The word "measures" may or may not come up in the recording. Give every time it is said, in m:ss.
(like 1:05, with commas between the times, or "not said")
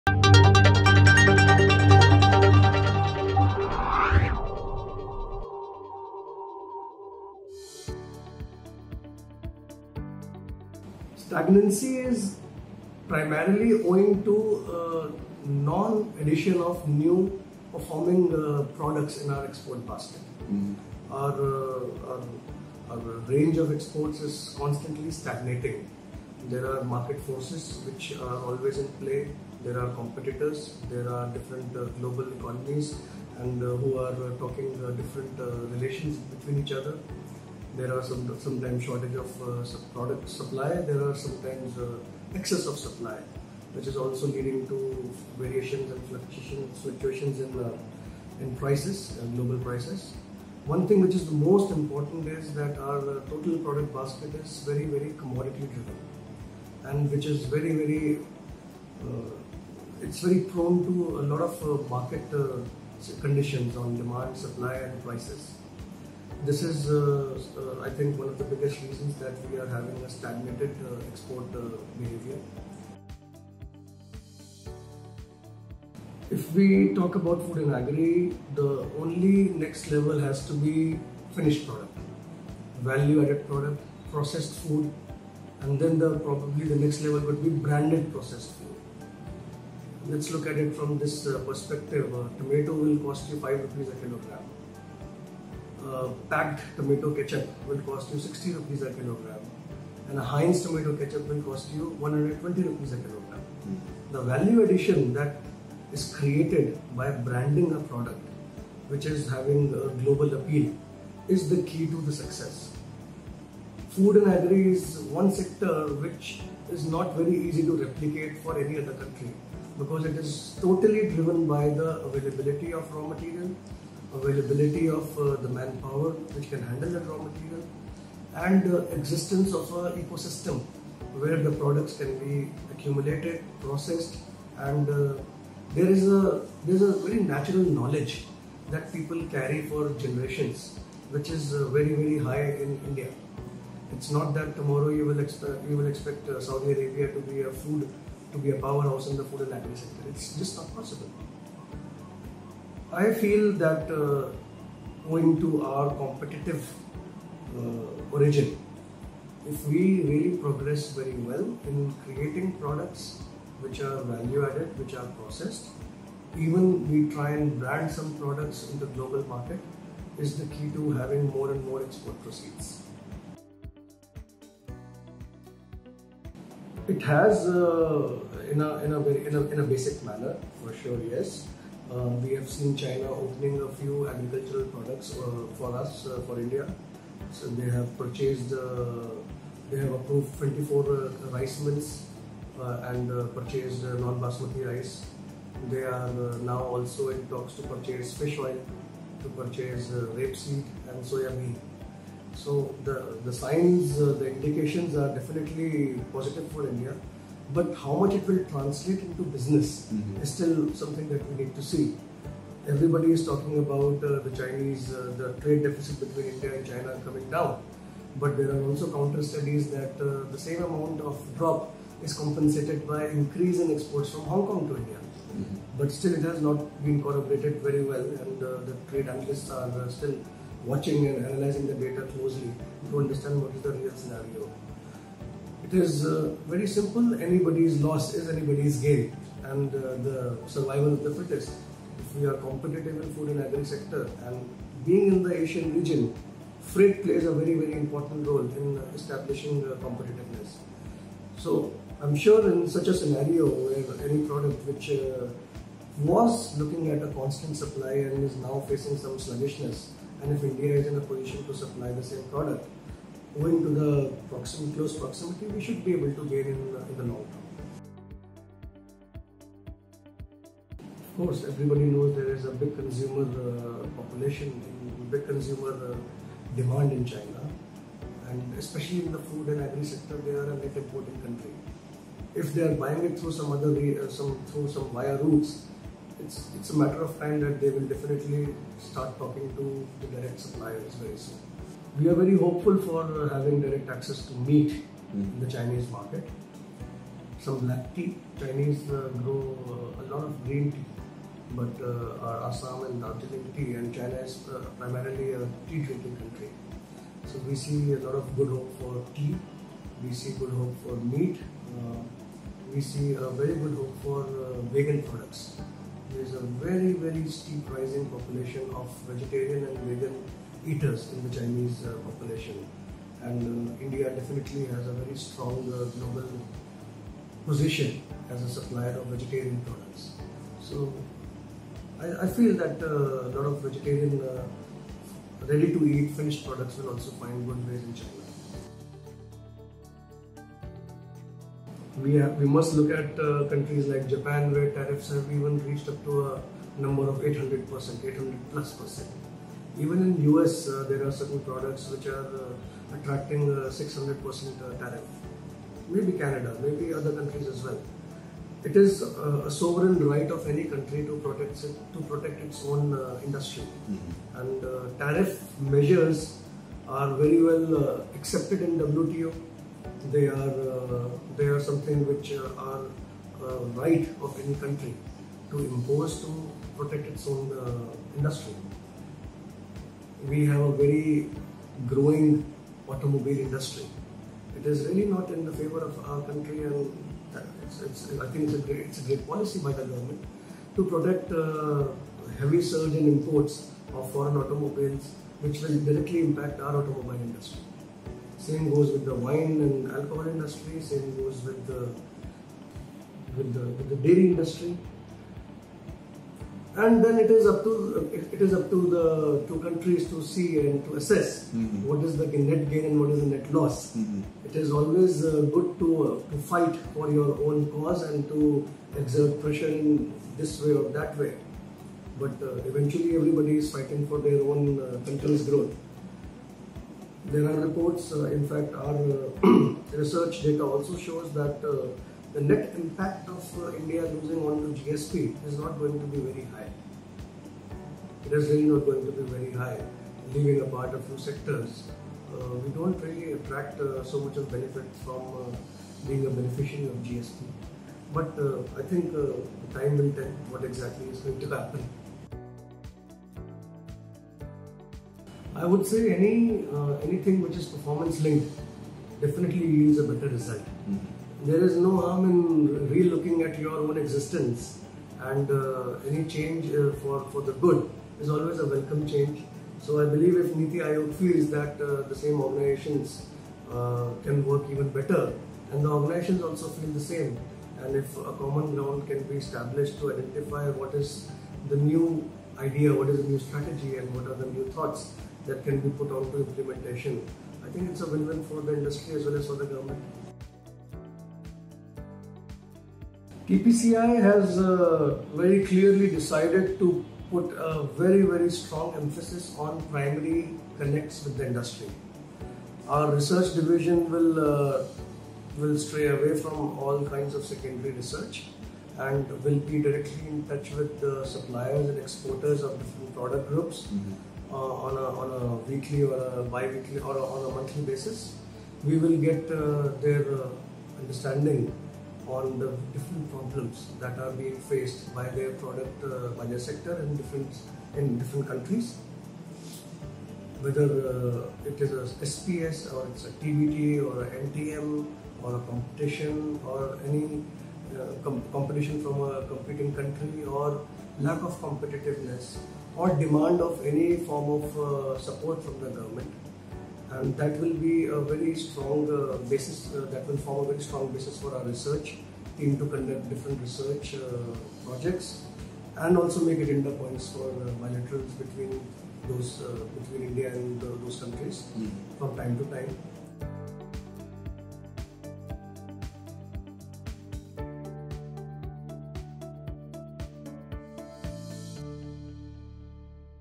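6:05.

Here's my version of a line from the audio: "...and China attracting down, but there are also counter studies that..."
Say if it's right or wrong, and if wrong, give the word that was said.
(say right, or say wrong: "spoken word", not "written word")
wrong: "coming", not "attracting".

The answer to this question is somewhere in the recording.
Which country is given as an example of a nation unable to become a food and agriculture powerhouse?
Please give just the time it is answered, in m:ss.
2:26.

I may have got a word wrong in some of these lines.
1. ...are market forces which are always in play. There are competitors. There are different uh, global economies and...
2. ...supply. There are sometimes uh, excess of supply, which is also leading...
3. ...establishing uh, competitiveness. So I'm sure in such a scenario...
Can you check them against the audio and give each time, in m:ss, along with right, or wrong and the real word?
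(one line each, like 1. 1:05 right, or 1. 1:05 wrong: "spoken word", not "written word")
1. 0:26 right
2. 0:40 right
3. 4:08 right.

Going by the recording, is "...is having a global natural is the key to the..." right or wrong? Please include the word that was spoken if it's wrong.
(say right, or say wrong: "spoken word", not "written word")
wrong: "appeal", not "natural".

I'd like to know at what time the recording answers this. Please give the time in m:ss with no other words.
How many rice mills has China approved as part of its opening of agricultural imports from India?
3:10.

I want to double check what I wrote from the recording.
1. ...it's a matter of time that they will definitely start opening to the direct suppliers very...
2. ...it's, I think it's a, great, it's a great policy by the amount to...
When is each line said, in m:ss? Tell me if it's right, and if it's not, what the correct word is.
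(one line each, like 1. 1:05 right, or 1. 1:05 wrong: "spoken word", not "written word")
1. 4:46 wrong: "talking", not "opening"
2. 6:27 wrong: "government", not "amount".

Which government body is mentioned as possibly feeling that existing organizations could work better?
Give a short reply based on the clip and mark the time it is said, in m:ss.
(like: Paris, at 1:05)
Niti Aayog, at 7:50.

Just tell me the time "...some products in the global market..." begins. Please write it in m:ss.
2:47.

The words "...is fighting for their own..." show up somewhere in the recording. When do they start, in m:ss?
7:03.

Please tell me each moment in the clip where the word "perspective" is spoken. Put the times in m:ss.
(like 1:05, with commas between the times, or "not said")
1:31.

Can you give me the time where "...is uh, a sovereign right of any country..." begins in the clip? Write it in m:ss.
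5:58.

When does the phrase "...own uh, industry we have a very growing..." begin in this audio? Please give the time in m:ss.
6:17.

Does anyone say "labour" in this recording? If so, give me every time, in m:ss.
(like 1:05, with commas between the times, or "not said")
not said.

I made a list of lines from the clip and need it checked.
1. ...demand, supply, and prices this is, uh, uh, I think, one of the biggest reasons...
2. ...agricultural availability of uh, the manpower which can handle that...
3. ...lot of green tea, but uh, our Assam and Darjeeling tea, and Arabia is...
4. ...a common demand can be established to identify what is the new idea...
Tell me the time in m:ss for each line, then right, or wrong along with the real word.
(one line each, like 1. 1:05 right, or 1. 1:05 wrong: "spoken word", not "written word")
1. 1:03 right
2. 2:03 wrong: "material", not "agricultural"
3. 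5:00 wrong: "China", not "Arabia"
4. 7:58 wrong: "ground", not "demand".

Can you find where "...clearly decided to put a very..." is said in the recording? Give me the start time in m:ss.
8:15.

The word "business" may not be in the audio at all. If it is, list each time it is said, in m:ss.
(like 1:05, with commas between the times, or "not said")
3:29.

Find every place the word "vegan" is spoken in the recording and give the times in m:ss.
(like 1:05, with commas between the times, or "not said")
5:14, 5:19.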